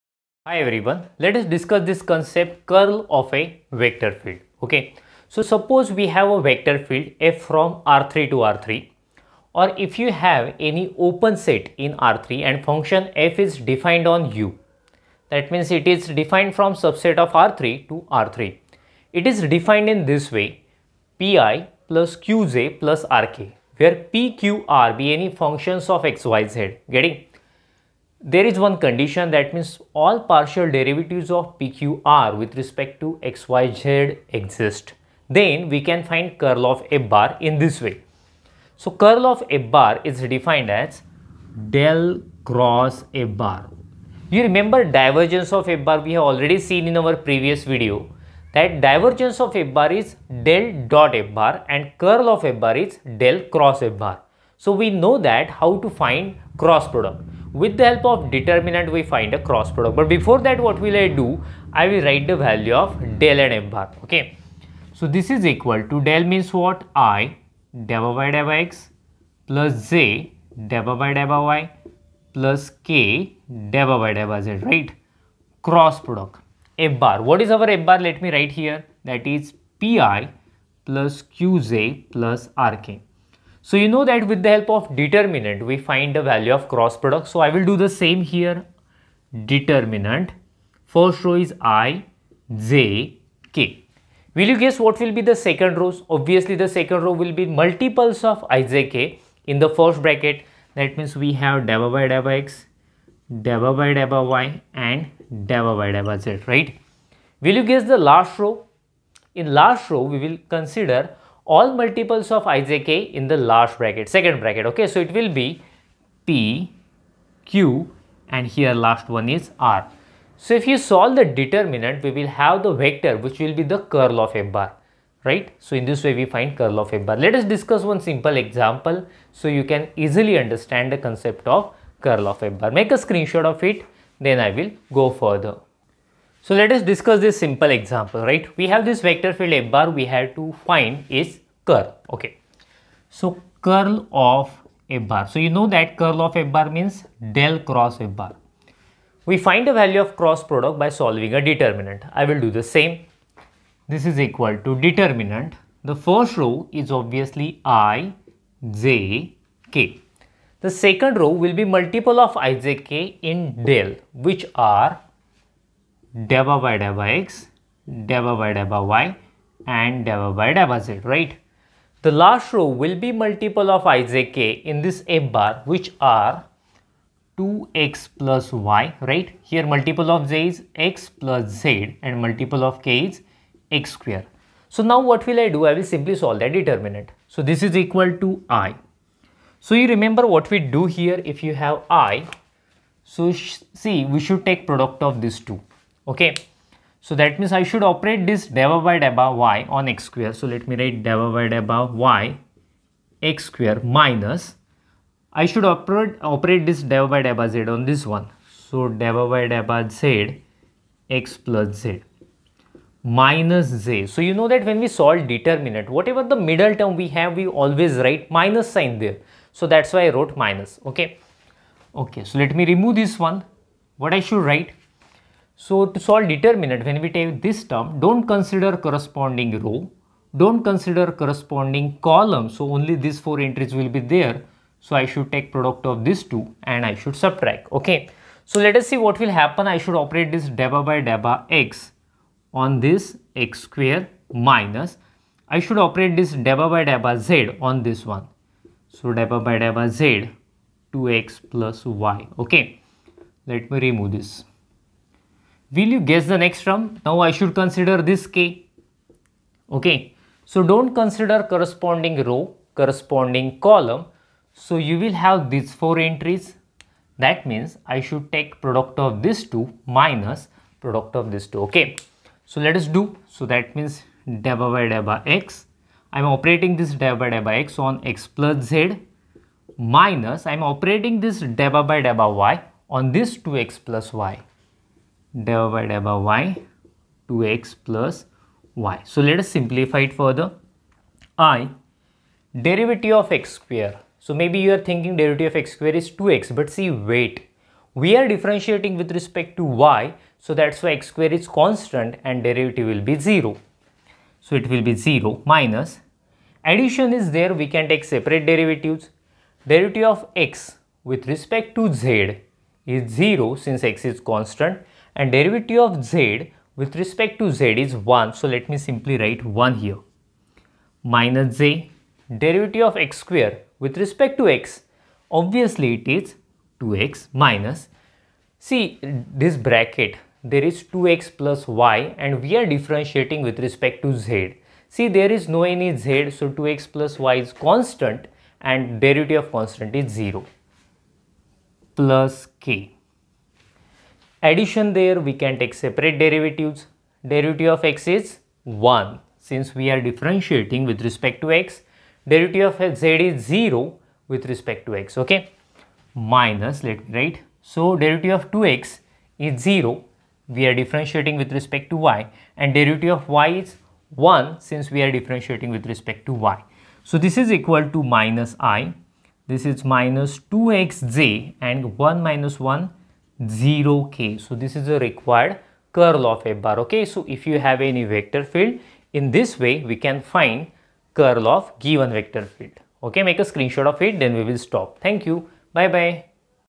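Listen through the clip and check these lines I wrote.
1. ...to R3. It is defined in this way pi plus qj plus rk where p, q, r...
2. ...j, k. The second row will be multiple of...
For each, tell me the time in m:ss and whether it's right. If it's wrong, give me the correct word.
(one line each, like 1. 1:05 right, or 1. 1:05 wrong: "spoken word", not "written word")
1. 0:17 right
2. 2:38 right.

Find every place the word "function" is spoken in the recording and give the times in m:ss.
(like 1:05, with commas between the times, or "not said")
0:12, 0:25.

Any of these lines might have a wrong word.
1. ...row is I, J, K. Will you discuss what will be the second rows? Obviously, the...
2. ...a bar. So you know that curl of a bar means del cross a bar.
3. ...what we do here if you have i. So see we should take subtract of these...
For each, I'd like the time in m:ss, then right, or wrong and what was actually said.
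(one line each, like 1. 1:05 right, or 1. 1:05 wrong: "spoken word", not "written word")
1. 1:31 wrong: "guess", not "discuss"
2. 2:24 right
3. 3:10 wrong: "product", not "subtract".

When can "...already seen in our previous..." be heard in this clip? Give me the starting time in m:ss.
0:46.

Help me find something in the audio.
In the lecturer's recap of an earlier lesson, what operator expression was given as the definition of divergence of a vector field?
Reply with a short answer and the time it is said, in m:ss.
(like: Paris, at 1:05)
del dot F bar, at 0:50.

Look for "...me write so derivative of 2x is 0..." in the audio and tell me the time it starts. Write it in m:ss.
5:57.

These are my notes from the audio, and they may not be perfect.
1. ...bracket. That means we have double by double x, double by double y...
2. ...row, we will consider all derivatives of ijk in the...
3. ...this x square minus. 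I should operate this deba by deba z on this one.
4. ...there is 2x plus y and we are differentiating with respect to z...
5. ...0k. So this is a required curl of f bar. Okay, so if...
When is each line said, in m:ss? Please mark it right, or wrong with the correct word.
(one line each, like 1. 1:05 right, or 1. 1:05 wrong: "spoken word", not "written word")
1. 1:40 right
2. 1:49 wrong: "multiples", not "derivatives"
3. 4:02 right
4. 5:30 right
5. 6:13 right.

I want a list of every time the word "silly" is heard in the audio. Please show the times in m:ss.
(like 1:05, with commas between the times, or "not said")
not said.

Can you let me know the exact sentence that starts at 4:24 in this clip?
So you will have these four entries.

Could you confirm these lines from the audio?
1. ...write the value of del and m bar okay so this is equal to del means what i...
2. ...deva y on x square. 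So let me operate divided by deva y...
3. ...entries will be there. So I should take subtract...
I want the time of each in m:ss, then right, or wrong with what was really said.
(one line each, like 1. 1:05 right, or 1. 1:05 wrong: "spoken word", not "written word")
1. 1:02 right
2. 3:18 wrong: "write", not "operate"
3. 3:53 wrong: "product", not "subtract".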